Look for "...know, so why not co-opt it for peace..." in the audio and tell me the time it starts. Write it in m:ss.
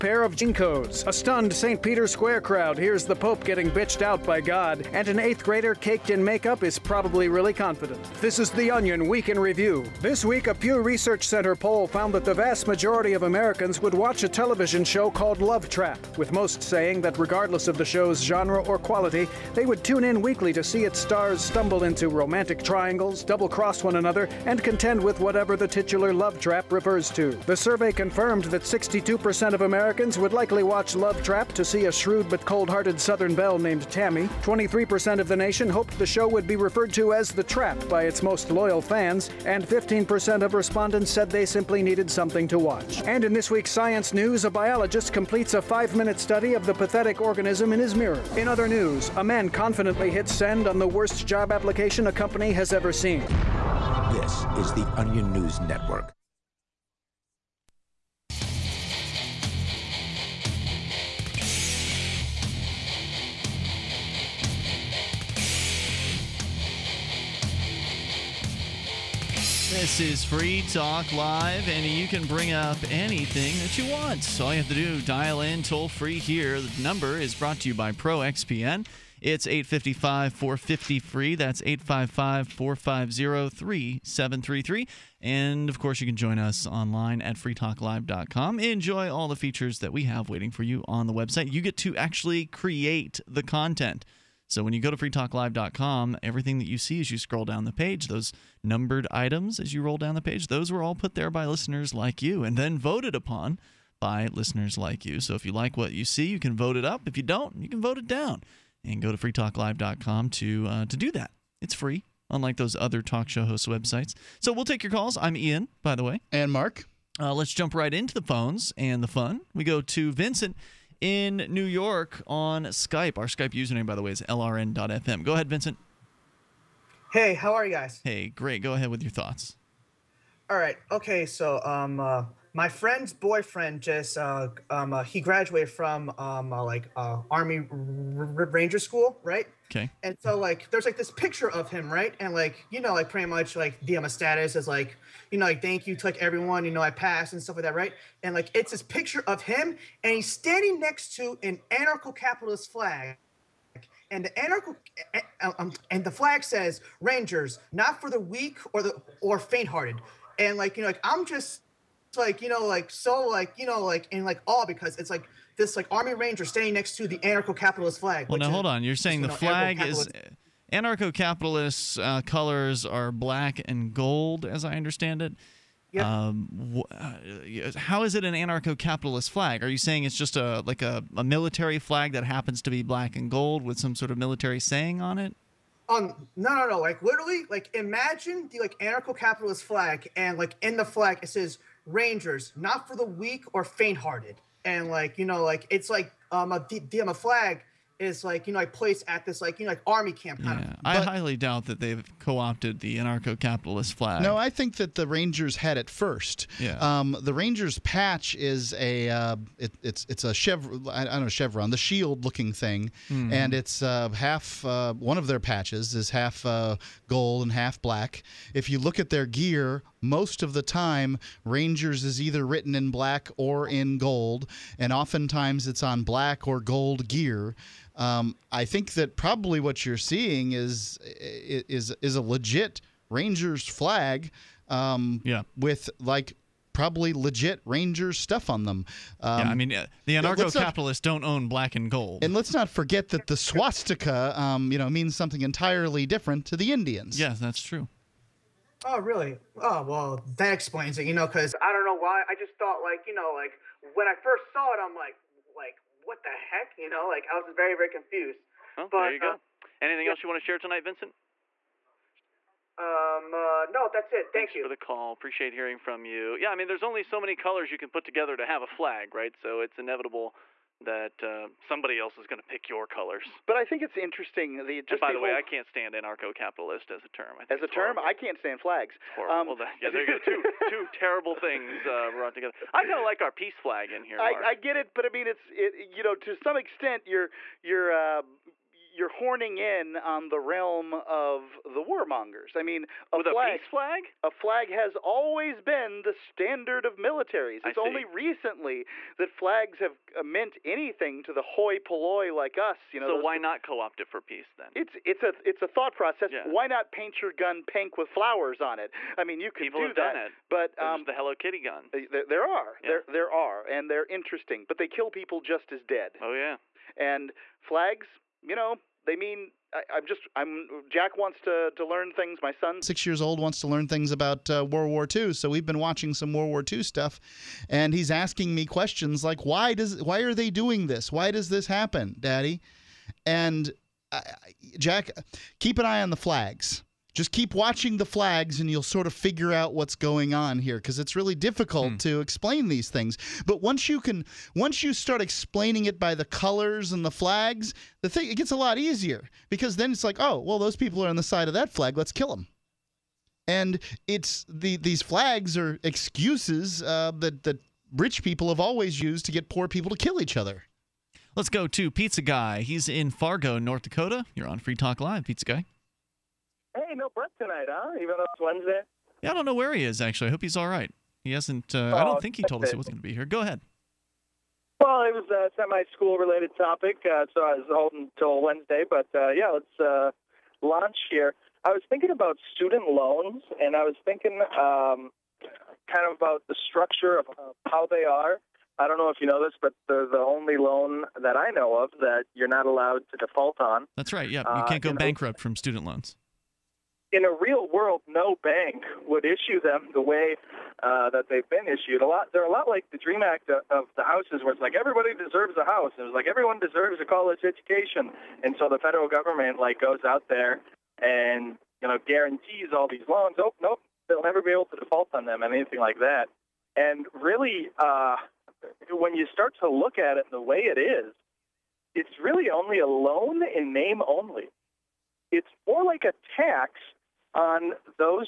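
5:02.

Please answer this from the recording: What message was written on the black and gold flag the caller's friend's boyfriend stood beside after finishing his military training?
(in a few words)
Rangers, not for the weak or faint-hearted.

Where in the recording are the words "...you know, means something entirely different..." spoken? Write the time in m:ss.
4:04.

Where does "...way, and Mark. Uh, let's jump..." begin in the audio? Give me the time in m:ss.
1:56.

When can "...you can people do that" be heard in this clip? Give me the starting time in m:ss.
5:09.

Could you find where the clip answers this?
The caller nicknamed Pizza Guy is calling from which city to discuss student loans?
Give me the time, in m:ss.
6:03.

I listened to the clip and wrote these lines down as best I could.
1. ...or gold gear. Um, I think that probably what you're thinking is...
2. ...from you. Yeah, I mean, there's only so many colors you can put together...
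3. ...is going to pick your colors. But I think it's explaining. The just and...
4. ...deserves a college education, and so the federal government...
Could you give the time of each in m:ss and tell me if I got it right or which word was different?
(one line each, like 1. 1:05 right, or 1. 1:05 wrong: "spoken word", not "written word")
1. 3:46 wrong: "seeing", not "thinking"
2. 4:25 right
3. 4:32 wrong: "interesting", not "explaining"
4. 6:46 right.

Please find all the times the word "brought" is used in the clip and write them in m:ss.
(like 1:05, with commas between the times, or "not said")
1:17, 4:42.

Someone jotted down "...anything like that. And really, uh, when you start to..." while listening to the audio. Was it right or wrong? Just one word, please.
right.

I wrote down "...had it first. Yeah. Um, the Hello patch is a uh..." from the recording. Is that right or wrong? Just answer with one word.
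wrong.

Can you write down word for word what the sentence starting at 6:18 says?
But uh, yeah, let's uh, launch here.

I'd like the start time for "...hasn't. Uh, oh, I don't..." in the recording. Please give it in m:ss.
6:11.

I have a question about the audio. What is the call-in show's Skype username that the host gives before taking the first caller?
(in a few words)
lrn.fm.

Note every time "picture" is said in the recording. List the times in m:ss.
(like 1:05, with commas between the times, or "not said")
2:21, 2:28.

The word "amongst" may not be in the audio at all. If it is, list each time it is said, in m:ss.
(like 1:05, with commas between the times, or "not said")
not said.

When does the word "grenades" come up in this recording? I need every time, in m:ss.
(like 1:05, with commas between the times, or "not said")
not said.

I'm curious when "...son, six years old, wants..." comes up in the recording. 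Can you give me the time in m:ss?
5:22.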